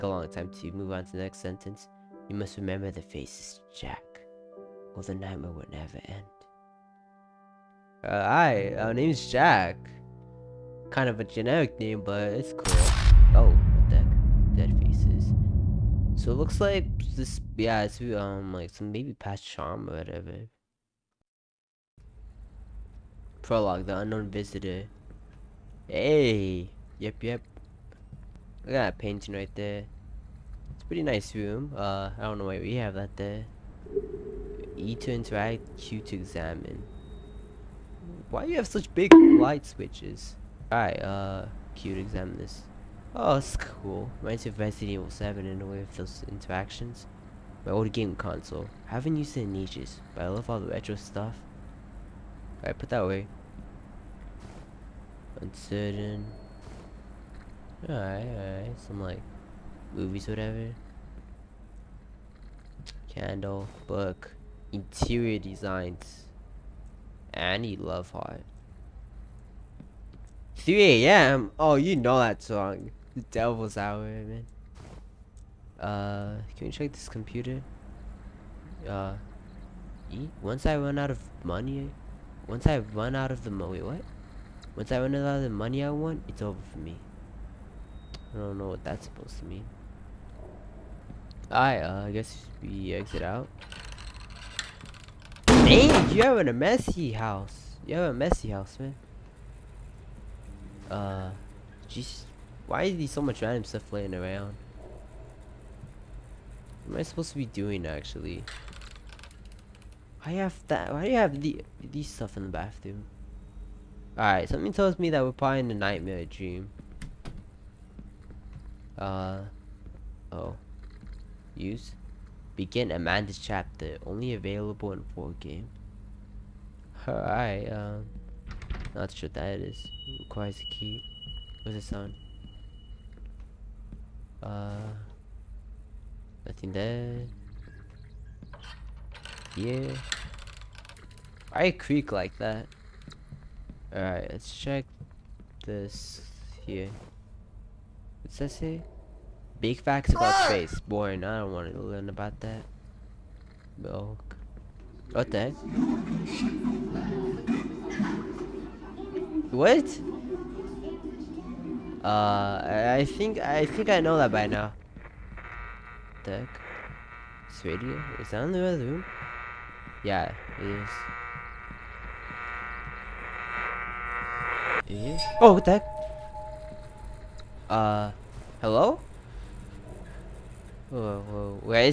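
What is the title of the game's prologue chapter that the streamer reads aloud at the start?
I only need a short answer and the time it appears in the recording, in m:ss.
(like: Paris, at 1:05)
The Unknown Visitor, at 0:23.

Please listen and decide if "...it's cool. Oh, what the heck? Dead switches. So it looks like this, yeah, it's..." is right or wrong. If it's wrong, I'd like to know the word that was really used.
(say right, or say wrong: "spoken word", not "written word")
wrong: "faces", not "switches".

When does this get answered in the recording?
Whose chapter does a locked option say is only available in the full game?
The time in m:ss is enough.
2:02.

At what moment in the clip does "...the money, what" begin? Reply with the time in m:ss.
1:23.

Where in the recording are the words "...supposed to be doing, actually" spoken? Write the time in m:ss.
1:47.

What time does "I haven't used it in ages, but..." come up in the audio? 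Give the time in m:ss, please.
0:48.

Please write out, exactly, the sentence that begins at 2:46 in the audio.
Tech, This radio is that in the other room?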